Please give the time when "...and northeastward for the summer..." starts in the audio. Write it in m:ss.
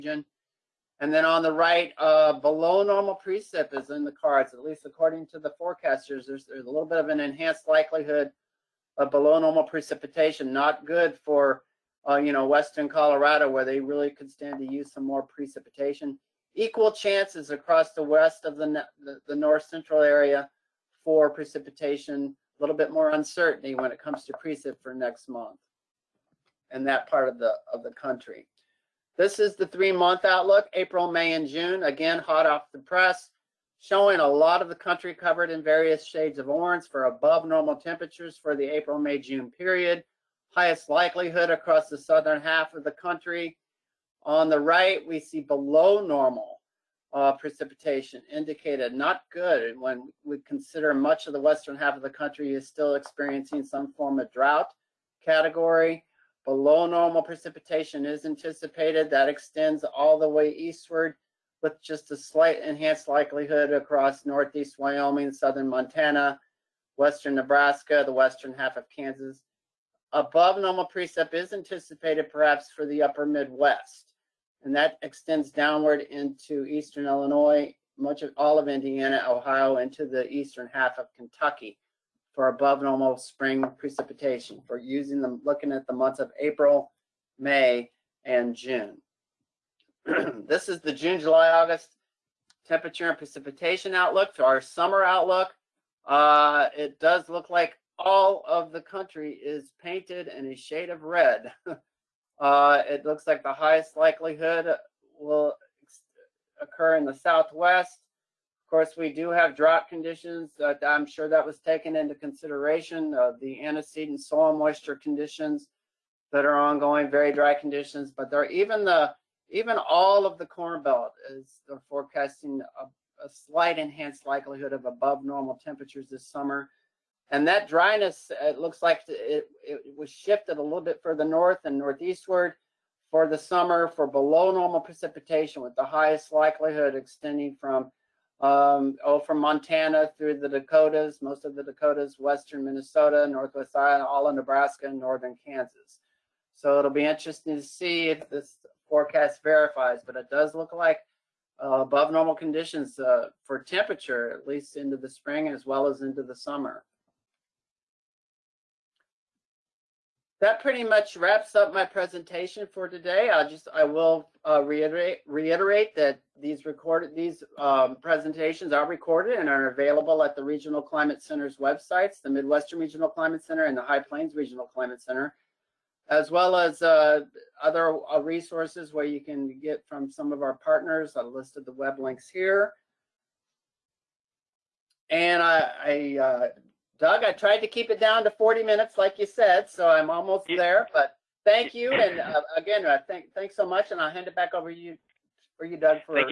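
2:11.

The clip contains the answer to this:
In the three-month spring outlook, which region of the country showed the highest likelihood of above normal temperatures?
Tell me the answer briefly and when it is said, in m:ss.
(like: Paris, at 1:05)
Southern half, at 0:41.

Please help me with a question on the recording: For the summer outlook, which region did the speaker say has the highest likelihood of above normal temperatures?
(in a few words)
Southwest.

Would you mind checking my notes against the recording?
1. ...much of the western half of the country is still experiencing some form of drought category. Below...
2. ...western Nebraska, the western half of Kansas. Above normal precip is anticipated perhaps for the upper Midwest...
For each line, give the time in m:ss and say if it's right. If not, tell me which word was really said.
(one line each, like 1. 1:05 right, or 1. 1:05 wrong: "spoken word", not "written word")
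1. 0:50 right
2. 1:06 right.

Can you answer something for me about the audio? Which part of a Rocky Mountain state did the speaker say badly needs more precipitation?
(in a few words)
Western Colorado.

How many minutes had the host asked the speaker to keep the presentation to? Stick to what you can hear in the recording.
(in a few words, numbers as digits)
40.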